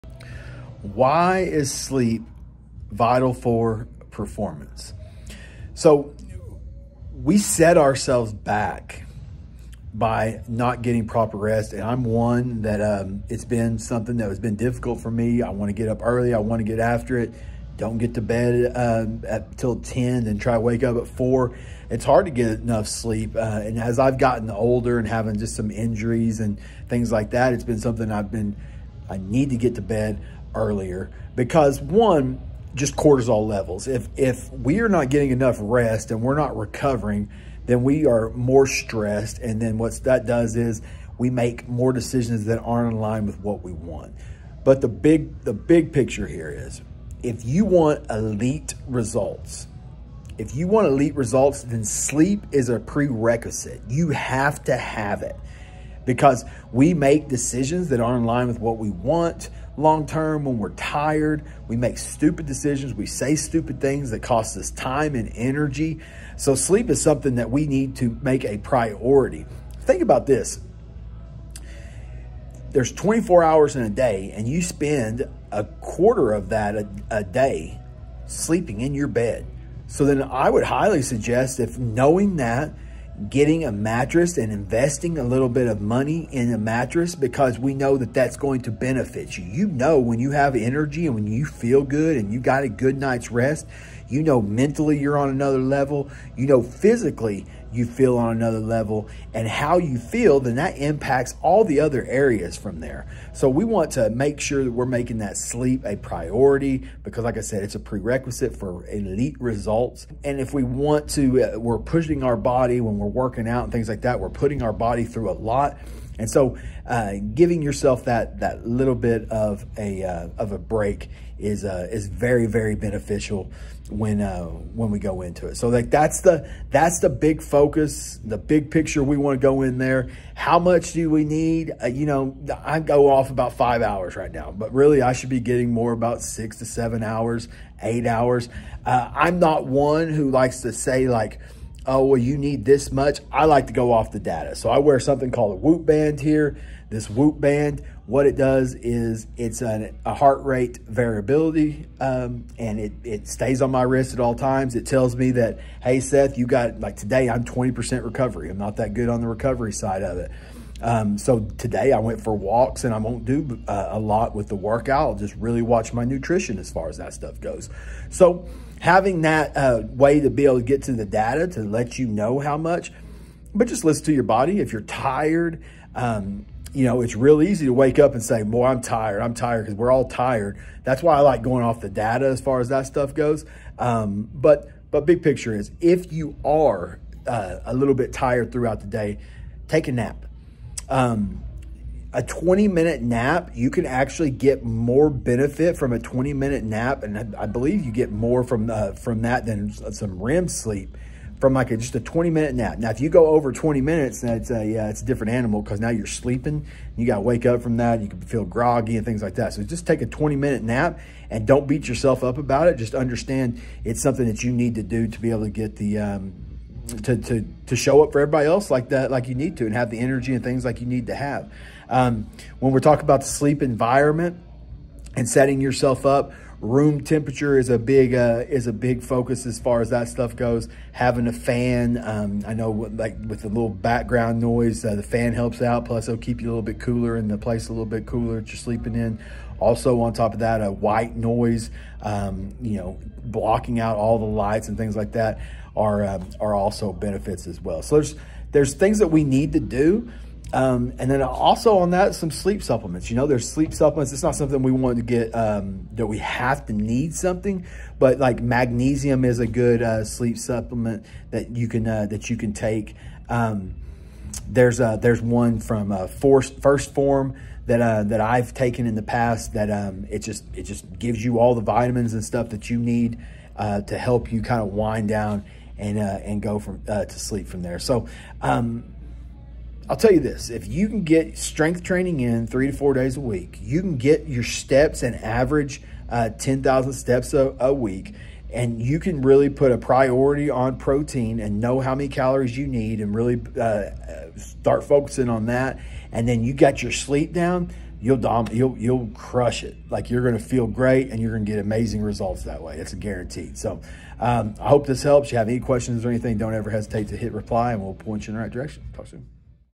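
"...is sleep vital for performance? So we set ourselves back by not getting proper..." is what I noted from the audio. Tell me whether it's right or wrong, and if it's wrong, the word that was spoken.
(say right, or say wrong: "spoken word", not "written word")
right.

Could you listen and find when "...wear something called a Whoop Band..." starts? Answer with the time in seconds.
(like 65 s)
144 s.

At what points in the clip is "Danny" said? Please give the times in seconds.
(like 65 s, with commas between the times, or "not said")
not said.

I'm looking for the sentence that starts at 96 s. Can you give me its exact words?
You know, physically, you feel on another level.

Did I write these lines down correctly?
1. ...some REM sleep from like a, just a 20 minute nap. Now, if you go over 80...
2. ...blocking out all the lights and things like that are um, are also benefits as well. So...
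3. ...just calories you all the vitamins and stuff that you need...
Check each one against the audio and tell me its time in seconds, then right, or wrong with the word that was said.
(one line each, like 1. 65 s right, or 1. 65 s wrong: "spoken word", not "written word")
1. 199 s wrong: "20", not "80"
2. 243 s right
3. 270 s wrong: "gives", not "calories".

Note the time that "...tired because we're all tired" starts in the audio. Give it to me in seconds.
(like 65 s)
179 s.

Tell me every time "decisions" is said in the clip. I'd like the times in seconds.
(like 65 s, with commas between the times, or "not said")
41 s, 57 s, 62 s.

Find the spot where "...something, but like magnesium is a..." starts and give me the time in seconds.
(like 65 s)
257 s.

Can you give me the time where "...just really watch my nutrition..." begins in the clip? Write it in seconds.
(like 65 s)
165 s.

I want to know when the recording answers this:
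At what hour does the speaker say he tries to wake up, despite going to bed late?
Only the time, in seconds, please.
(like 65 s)
21 s.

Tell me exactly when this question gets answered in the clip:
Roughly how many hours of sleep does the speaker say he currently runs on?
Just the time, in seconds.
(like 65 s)
133 s.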